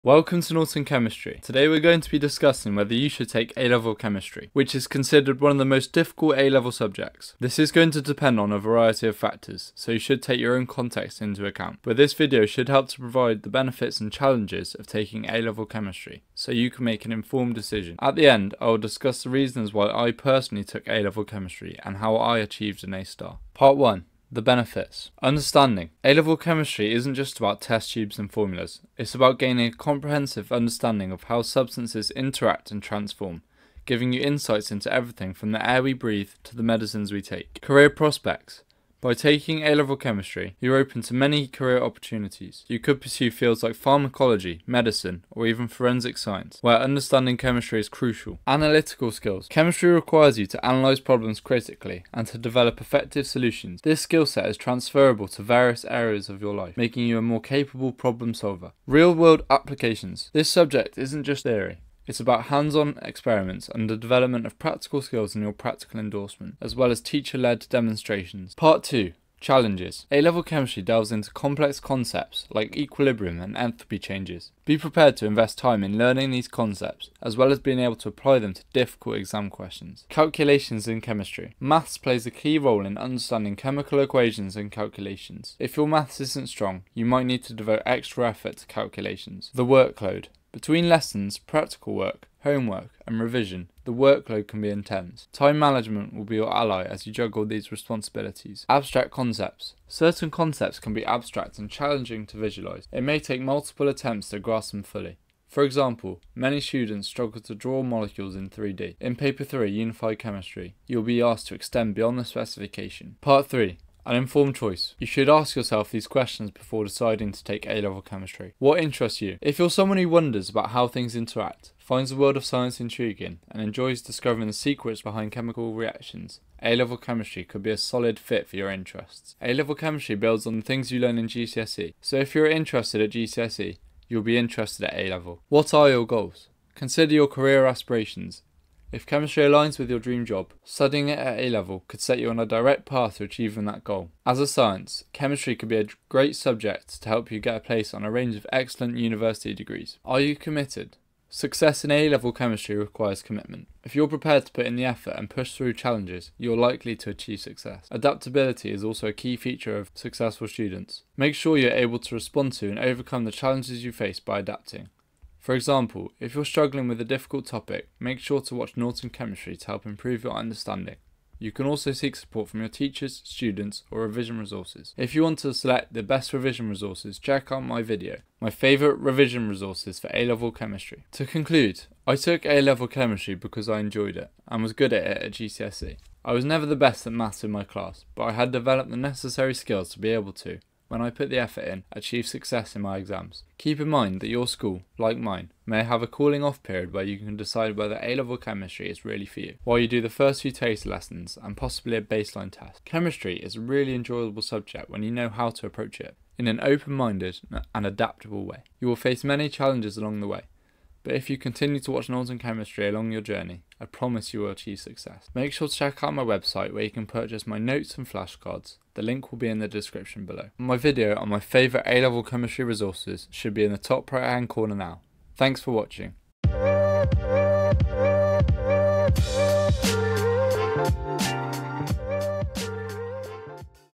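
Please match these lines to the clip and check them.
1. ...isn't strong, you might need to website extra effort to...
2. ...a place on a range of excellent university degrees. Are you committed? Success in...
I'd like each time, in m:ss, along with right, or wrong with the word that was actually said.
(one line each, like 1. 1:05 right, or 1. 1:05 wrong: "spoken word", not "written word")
1. 1:26 wrong: "devote", not "website"
2. 2:27 right.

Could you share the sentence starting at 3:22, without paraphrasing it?
Chemistry is a really enjoyable subject when you know how to approach it in an open minded and adaptable way.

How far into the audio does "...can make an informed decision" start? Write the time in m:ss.
0:16.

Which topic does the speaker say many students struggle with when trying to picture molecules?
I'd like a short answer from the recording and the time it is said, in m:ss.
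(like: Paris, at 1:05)
Drawing molecules in 3D, at 1:47.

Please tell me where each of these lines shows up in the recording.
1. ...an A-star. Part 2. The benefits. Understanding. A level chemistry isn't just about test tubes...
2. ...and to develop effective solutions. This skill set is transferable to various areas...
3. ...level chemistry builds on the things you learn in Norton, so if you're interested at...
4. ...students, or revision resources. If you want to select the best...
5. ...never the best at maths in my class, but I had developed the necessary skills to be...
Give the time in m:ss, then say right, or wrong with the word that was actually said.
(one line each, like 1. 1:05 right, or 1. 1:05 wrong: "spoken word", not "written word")
1. 0:22 wrong: "1", not "2"
2. 0:52 right
3. 2:09 wrong: "GCSE", not "Norton"
4. 2:53 right
5. 3:06 right.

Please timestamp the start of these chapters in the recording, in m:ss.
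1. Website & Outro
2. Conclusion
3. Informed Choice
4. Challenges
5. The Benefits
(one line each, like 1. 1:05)
1. 3:35
2. 3:00
3. 1:53
4. 1:08
5. 0:22.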